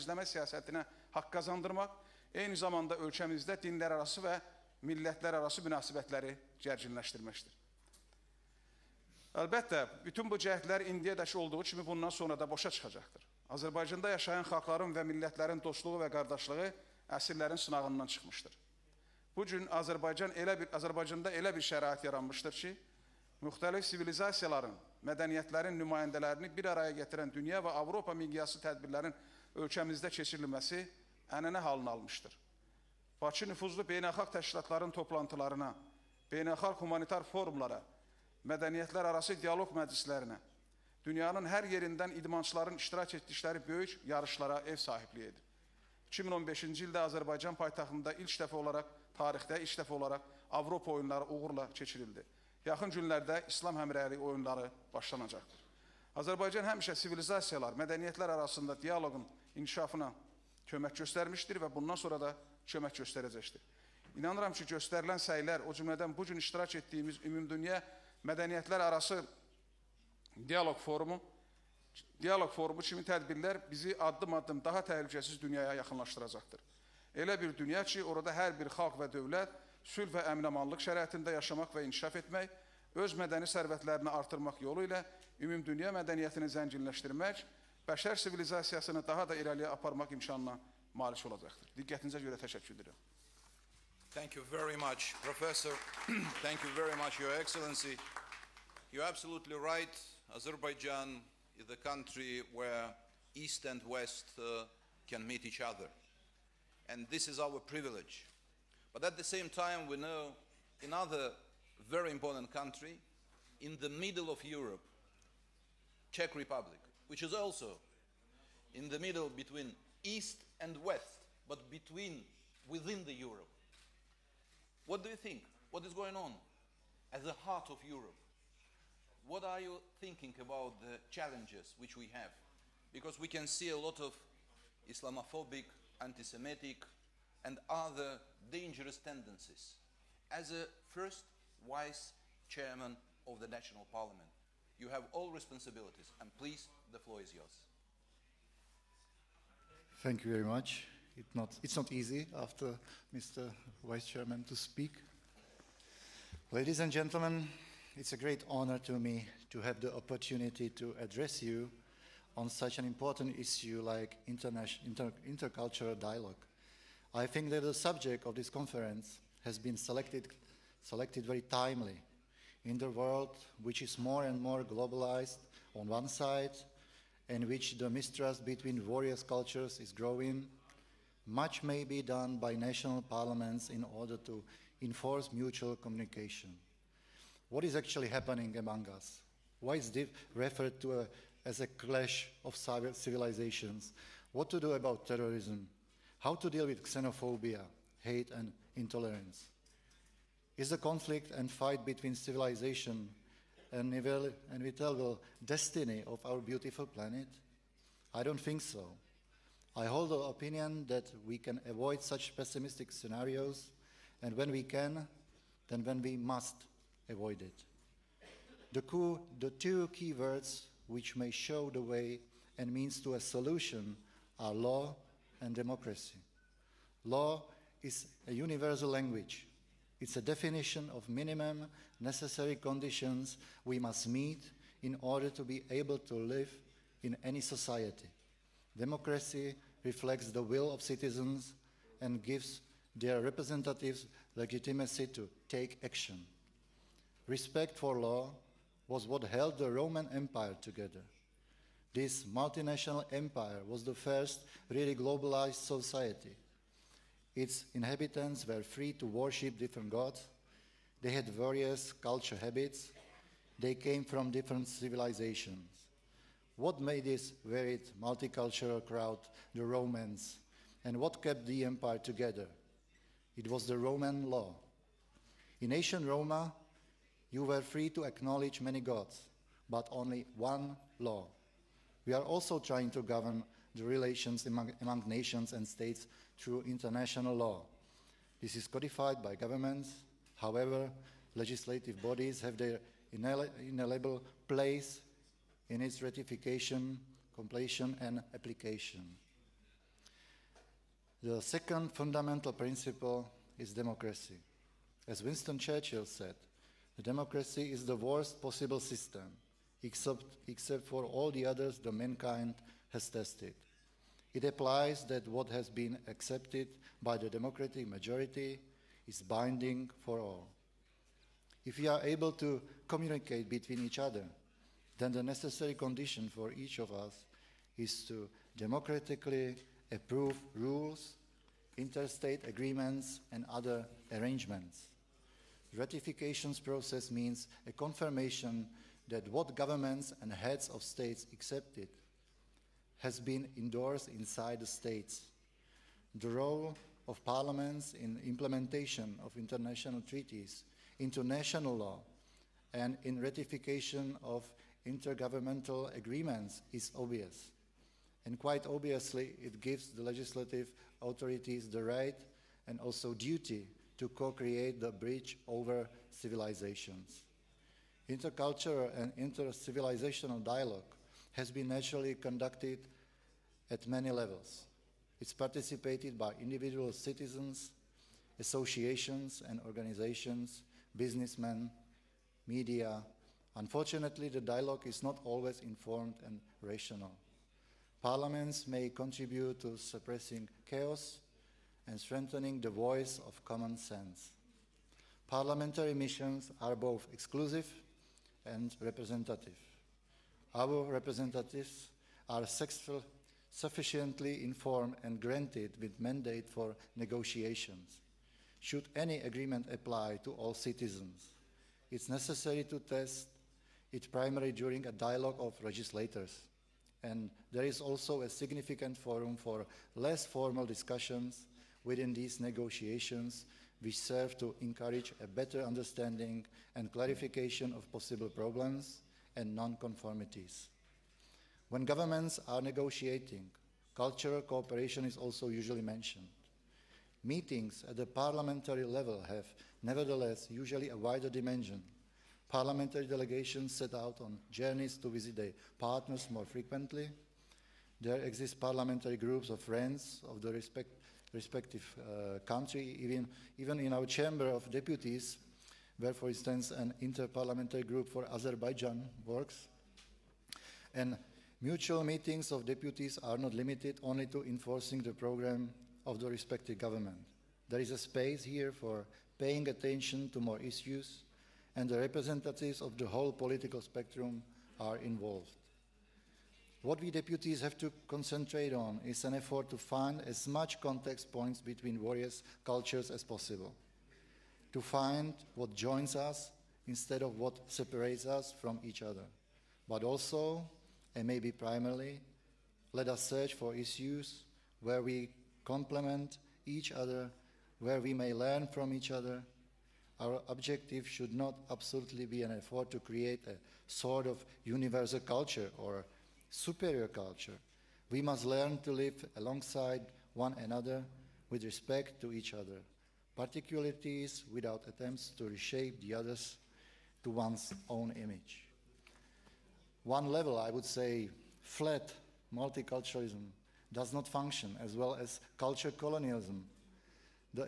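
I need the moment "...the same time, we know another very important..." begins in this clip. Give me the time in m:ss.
1:49.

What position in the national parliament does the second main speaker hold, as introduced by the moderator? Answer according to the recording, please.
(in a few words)
First vice chairman.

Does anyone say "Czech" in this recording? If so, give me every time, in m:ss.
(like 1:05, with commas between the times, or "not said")
1:56.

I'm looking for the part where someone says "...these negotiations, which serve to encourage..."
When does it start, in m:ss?
7:02.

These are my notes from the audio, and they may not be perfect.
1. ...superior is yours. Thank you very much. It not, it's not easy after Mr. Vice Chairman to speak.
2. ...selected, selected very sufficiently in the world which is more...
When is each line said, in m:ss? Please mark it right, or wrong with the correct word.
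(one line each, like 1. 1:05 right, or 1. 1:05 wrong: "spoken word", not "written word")
1. 2:26 wrong: "floor", not "superior"
2. 2:49 wrong: "timely", not "sufficiently".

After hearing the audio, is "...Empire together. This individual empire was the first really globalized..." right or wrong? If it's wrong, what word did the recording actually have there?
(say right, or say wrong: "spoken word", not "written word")
wrong: "multinational", not "individual".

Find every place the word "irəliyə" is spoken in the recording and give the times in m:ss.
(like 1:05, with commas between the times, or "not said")
1:29.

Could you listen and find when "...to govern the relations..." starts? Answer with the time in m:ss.
4:42.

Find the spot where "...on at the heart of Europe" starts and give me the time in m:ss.
2:06.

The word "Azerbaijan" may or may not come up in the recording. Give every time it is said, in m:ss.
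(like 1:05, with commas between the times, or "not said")
1:40, 7:38.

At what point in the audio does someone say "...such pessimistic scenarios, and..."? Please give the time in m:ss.
3:32.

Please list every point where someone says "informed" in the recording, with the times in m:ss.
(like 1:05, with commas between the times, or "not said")
6:25, 6:44.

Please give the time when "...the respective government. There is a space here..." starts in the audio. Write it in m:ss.
7:46.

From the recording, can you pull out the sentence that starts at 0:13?
Azərbaycanda yaşayan xalqların və millətlərin dostluğu və qardaşlığı əsrlərin sınağından çıxmışdır.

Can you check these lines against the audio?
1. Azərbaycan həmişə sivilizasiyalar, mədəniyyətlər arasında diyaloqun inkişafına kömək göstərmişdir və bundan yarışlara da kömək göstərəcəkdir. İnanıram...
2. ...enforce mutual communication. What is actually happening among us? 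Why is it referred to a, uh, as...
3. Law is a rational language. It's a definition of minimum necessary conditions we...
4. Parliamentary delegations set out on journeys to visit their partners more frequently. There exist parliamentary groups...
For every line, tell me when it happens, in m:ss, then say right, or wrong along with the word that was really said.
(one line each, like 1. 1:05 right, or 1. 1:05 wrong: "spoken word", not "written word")
1. 0:56 wrong: "sonra", not "yarışlara"
2. 3:04 right
3. 3:47 wrong: "universal", not "rational"
4. 7:22 right.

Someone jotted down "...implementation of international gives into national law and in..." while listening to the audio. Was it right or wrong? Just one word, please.
wrong.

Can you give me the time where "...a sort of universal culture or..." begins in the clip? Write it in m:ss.
8:23.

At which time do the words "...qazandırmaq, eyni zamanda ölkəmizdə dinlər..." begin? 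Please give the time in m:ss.
0:01.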